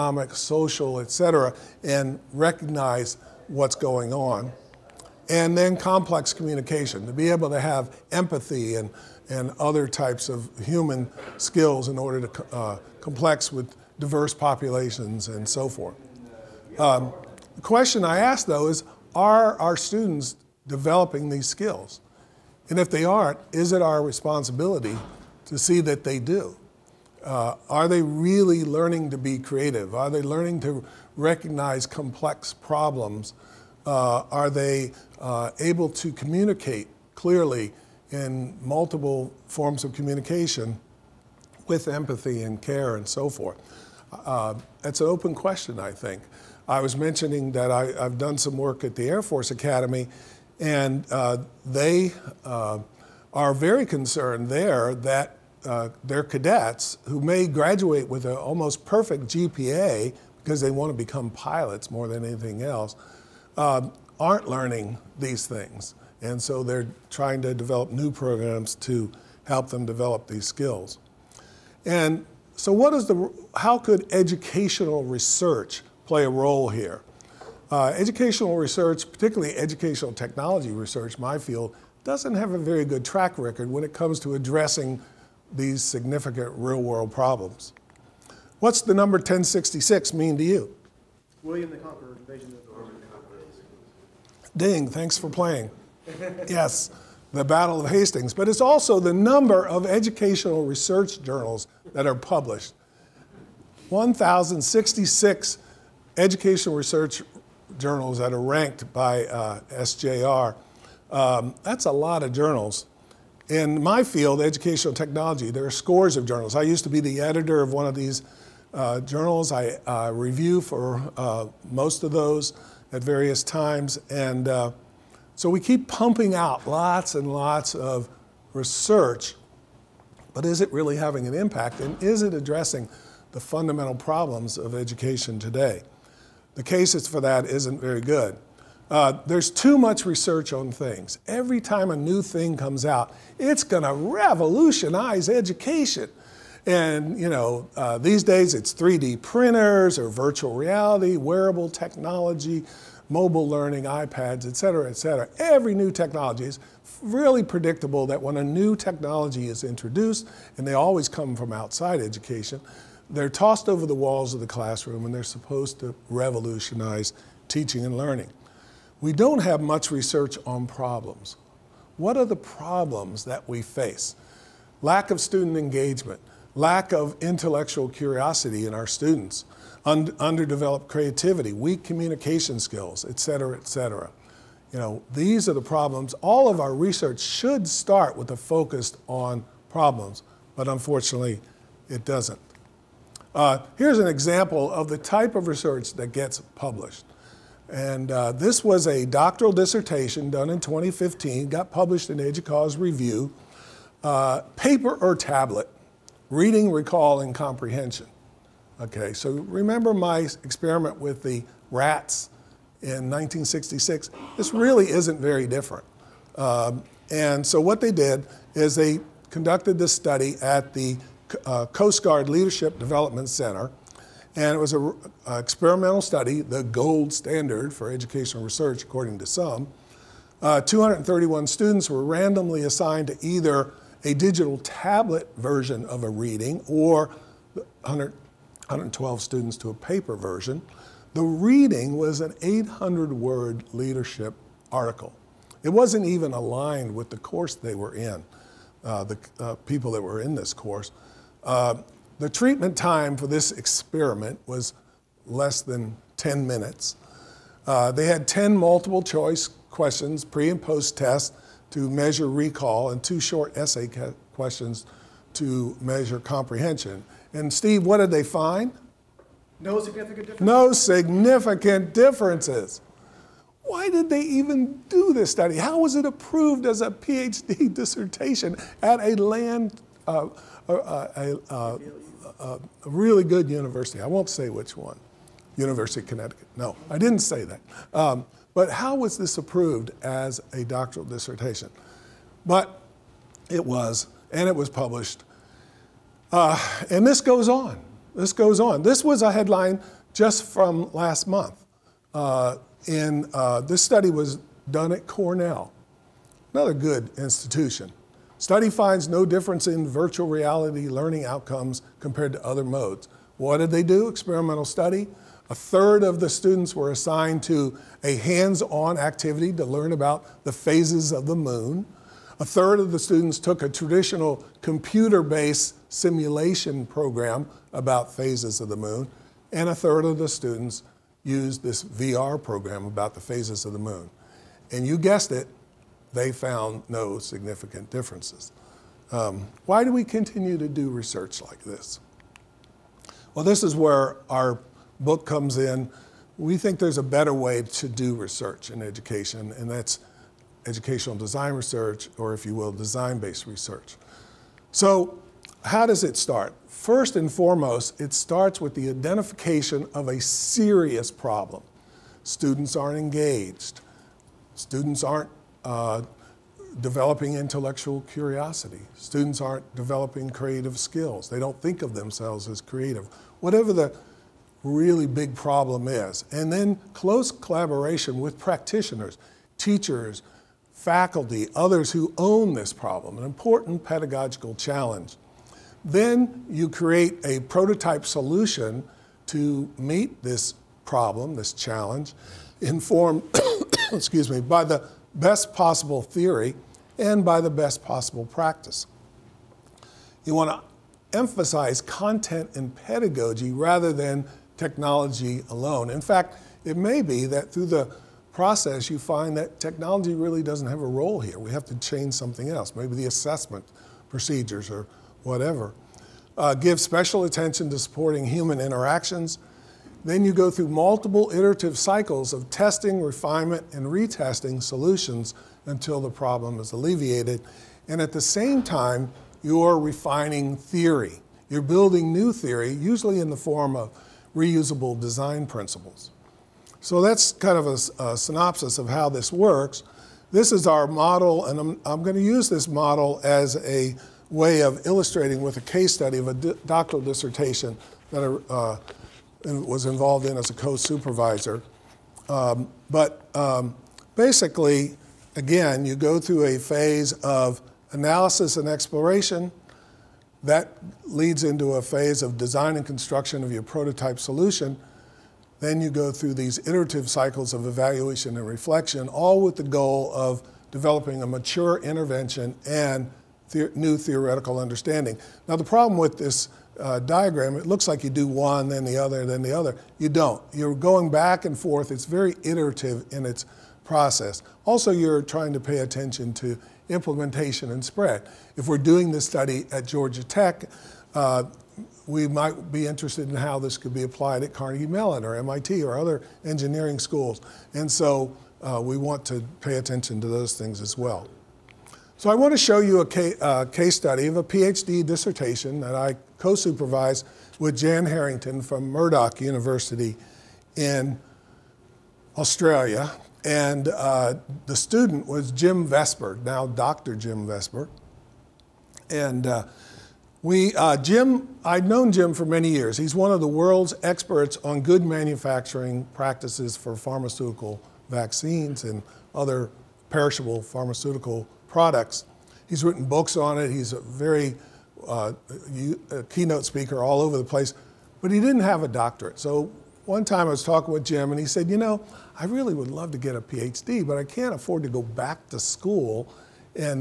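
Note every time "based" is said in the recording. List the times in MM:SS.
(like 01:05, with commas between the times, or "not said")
05:24, 05:52.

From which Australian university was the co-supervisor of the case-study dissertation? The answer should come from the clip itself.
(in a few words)
Murdoch University.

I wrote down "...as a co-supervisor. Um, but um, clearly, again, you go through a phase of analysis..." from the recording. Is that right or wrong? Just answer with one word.
wrong.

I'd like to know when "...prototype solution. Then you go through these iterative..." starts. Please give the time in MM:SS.
07:43.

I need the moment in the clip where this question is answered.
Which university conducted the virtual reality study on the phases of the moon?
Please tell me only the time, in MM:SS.
05:05.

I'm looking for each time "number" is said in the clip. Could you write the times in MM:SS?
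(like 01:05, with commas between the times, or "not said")
01:28, 01:39.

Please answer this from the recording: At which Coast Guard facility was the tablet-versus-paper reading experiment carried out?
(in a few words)
Coast Guard Leadership Development Center.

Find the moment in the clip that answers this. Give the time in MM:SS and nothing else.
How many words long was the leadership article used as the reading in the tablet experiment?
04:02.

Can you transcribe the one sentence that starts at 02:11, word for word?
And is it addressing the fundamental problems of education today?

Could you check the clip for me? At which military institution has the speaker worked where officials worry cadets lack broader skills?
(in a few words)
Air Force Academy.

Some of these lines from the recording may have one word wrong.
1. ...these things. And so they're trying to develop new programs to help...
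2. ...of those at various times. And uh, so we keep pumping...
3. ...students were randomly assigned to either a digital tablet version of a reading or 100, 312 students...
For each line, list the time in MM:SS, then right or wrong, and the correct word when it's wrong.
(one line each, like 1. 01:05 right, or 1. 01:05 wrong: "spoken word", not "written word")
1. 01:05 right
2. 02:02 right
3. 03:51 wrong: "112", not "312".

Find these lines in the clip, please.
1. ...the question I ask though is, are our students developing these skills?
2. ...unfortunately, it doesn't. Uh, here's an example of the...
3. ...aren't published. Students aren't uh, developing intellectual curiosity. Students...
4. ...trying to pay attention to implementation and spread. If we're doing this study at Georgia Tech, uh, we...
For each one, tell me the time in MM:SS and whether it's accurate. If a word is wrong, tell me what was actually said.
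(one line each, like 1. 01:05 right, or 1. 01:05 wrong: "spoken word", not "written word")
1. 00:17 right
2. 03:10 right
3. 06:02 wrong: "engaged", not "published"
4. 08:05 right.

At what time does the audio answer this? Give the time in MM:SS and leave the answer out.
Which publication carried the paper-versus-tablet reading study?
03:22.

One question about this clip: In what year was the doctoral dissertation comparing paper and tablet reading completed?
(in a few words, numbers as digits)
2015.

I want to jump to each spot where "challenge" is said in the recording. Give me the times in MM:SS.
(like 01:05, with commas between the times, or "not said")
06:24, 06:31.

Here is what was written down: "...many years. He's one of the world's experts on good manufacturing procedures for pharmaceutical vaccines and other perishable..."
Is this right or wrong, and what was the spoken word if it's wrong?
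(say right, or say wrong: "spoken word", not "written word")
wrong: "practices", not "procedures".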